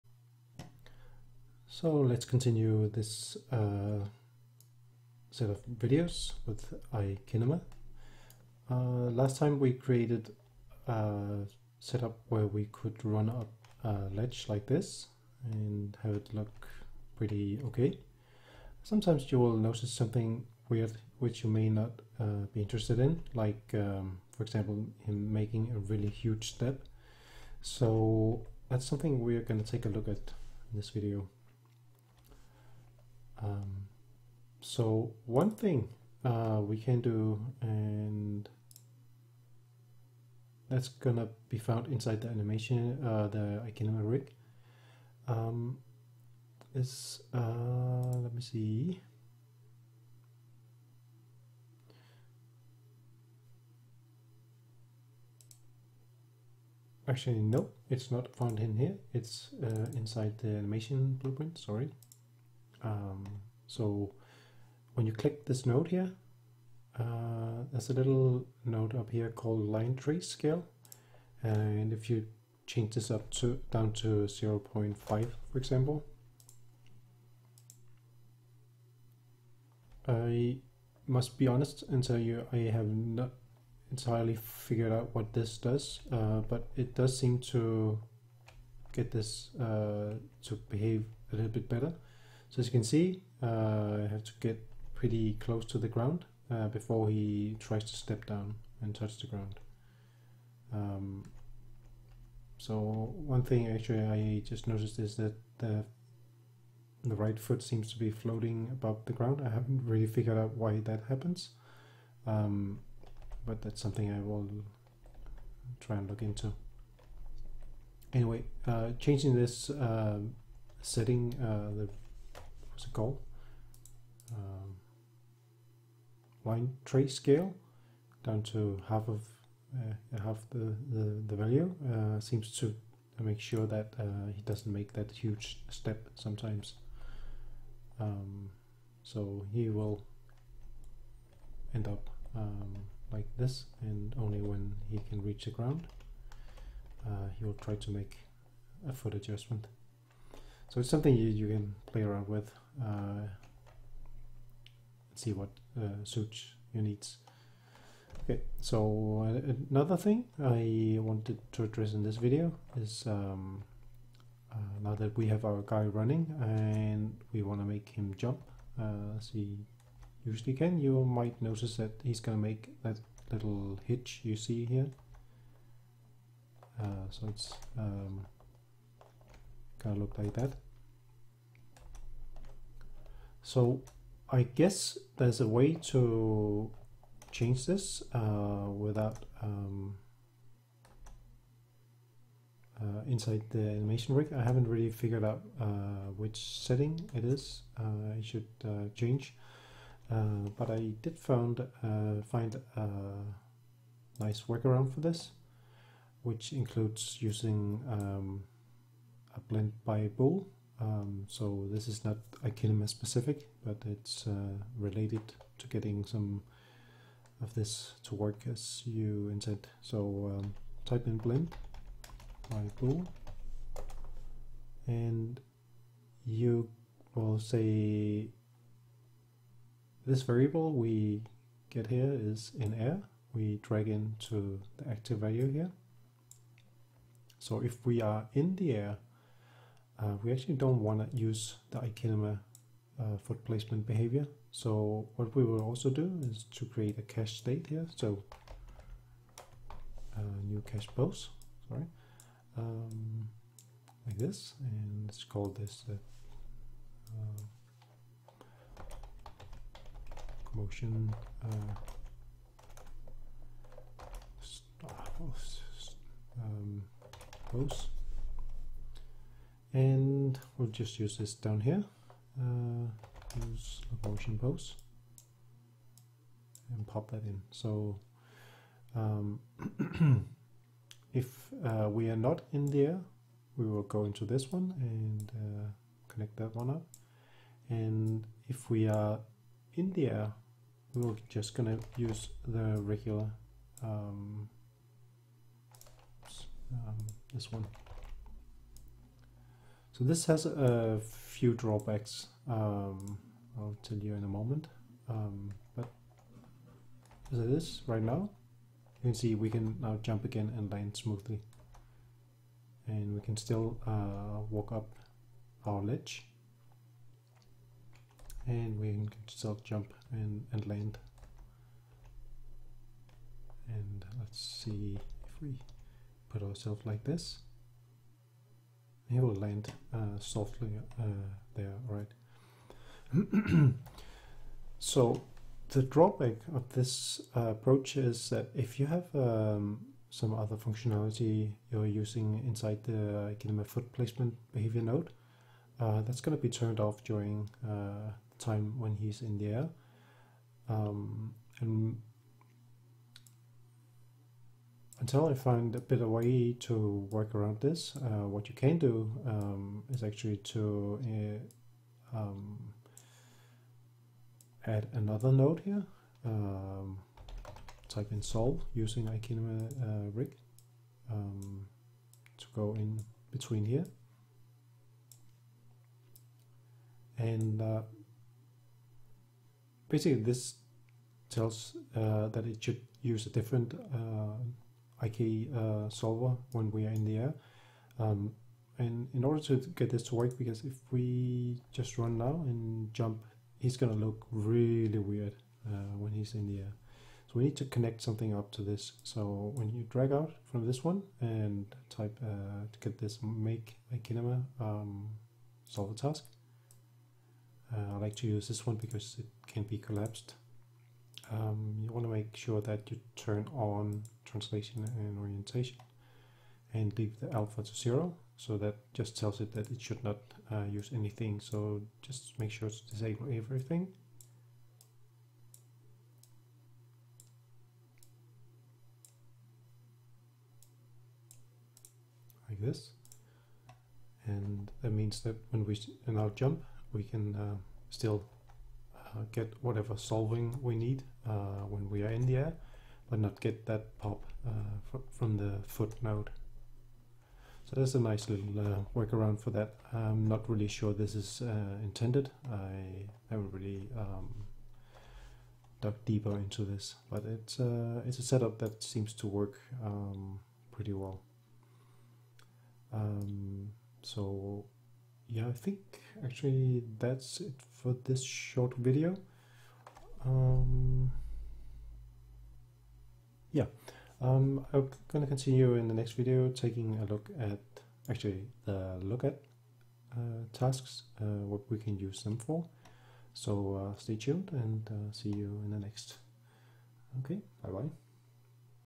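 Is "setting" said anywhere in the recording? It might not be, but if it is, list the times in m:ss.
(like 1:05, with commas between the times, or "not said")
2:00, 3:16.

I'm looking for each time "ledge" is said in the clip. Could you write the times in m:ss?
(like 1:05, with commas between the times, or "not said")
0:14, 5:15.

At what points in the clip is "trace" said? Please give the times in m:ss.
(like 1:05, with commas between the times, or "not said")
1:09, 2:06.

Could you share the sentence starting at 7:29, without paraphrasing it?
I'm not really sure this is uh, intended.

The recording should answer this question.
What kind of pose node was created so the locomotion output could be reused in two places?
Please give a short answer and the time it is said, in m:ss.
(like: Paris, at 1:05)
cache pose, at 4:10.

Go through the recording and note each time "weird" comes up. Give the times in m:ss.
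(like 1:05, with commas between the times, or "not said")
0:20, 6:34.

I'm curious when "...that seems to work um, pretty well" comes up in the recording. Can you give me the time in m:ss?
7:38.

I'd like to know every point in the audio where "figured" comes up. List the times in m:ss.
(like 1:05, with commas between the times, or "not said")
1:24, 1:50, 3:14.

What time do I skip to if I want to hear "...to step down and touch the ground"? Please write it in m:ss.
1:37.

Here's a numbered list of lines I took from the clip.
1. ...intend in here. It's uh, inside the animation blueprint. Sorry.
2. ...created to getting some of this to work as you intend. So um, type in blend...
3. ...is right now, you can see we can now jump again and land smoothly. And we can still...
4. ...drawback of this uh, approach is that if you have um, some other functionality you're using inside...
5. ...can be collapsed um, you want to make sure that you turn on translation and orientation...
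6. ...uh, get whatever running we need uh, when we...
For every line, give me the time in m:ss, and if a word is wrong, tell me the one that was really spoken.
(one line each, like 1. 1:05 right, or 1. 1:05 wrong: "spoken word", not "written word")
1. 0:58 wrong: "found", not "intend"
2. 3:34 wrong: "related", not "created"
3. 5:07 right
4. 5:35 right
5. 6:49 right
6. 7:19 wrong: "solving", not "running".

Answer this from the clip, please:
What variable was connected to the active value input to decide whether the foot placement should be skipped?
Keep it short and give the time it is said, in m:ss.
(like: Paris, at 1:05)
is in air, at 3:52.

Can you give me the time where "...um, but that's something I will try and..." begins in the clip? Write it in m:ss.
1:52.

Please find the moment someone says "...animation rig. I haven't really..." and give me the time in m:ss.
3:13.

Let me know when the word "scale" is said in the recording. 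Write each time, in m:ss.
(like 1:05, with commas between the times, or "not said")
1:10, 2:07.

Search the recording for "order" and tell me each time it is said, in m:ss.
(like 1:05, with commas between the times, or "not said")
6:29.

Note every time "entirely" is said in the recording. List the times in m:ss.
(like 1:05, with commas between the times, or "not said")
1:23.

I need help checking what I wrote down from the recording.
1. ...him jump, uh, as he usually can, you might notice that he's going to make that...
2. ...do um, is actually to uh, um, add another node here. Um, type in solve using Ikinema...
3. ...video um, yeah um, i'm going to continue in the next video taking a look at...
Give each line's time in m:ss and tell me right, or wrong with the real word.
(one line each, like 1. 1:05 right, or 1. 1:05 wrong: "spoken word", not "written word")
1. 2:47 right
2. 5:58 right
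3. 7:48 right.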